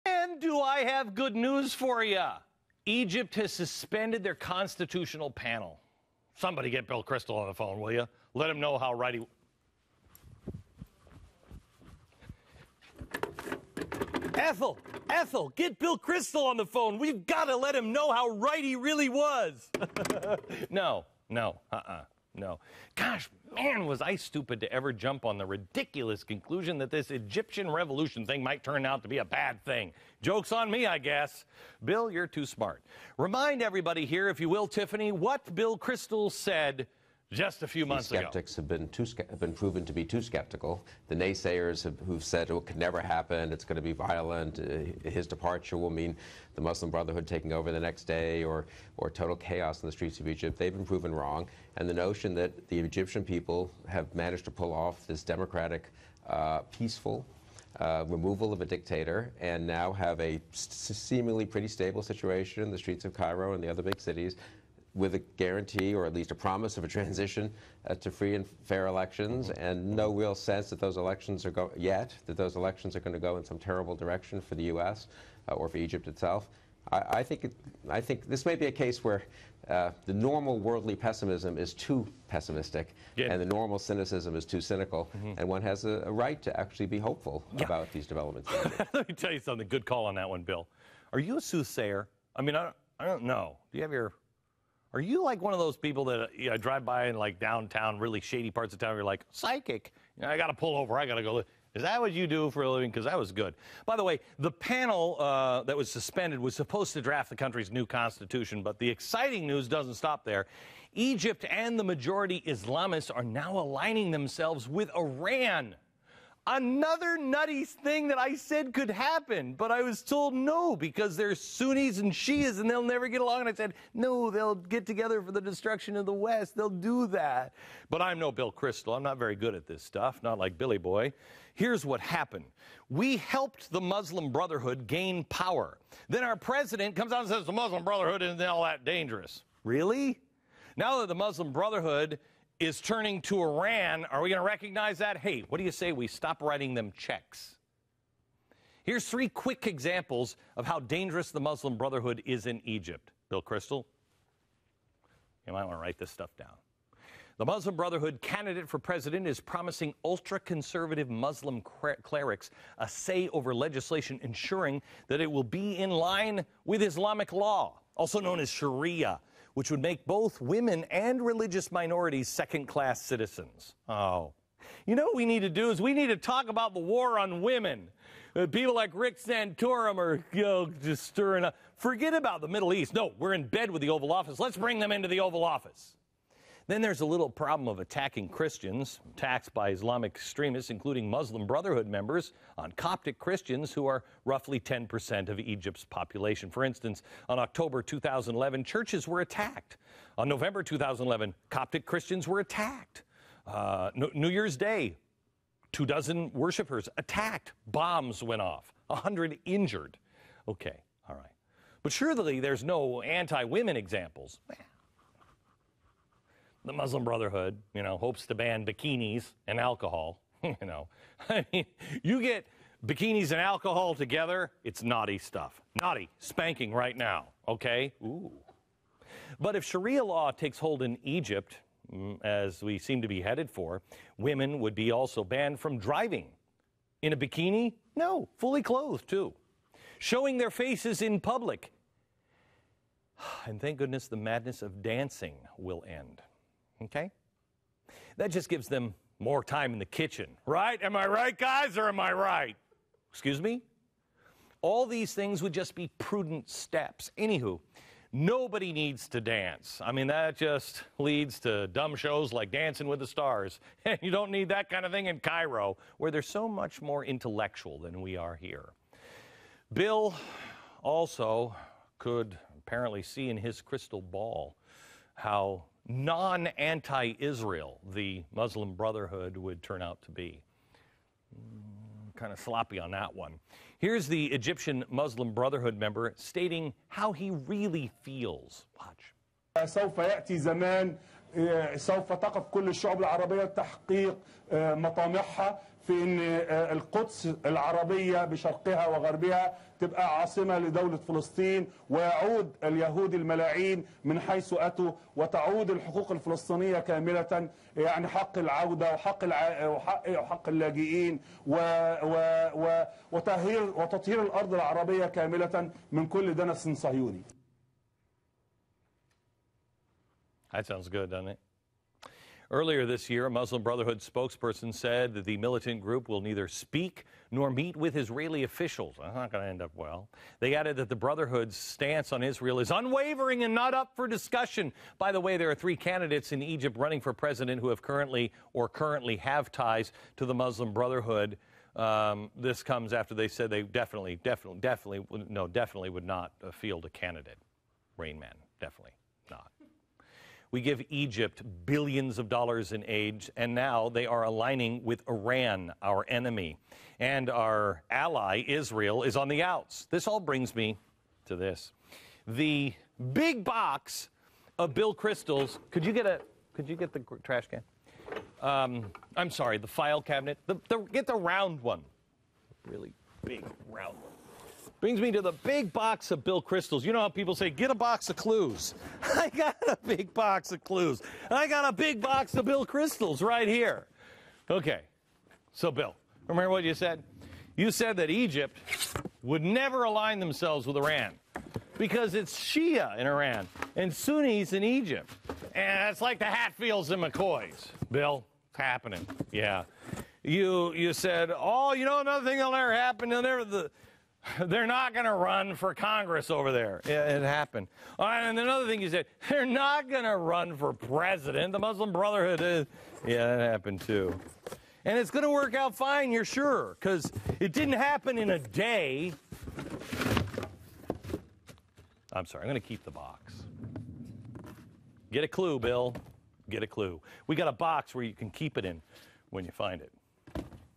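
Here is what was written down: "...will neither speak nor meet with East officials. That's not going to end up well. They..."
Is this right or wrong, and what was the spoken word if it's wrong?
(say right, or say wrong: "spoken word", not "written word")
wrong: "Israeli", not "East".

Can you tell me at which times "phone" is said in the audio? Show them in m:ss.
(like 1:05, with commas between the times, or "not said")
0:07, 0:16.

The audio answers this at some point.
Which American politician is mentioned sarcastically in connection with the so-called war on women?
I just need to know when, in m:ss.
2:58.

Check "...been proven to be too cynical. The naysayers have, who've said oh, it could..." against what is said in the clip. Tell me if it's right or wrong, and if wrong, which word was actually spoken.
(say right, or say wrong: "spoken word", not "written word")
wrong: "skeptical", not "cynical".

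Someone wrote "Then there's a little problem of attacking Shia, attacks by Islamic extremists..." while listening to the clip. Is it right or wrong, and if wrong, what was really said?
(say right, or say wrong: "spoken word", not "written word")
wrong: "Christians", not "Shia".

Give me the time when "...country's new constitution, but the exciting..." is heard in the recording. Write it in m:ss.
1:47.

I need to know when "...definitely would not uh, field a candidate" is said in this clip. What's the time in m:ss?
5:45.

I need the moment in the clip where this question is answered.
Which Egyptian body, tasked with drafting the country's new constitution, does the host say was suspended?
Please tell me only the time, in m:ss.
0:04.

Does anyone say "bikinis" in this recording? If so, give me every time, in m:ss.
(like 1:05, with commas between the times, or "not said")
3:38, 3:42, 3:57.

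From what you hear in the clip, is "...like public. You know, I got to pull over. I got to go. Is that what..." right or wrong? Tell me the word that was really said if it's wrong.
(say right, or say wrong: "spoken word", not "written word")
wrong: "psychic", not "public".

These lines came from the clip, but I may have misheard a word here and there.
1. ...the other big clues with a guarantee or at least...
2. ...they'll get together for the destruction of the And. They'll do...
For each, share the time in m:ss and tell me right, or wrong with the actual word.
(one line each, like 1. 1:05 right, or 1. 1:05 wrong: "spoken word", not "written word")
1. 1:03 wrong: "cities", not "clues"
2. 2:04 wrong: "West", not "And".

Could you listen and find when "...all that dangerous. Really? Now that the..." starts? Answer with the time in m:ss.
2:18.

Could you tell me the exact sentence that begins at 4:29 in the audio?
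Bill also could apparently see in his crystal ball how non anti Israel the Muslim Brotherhood would turn out to be.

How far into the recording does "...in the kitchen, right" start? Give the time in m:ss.
4:09.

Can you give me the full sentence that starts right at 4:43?
Here's the Egyptian Muslim Brotherhood member stating how he really feels.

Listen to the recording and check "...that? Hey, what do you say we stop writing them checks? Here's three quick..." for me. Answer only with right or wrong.
right.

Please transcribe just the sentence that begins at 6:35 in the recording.
And it's like the Hatfields and McCoys.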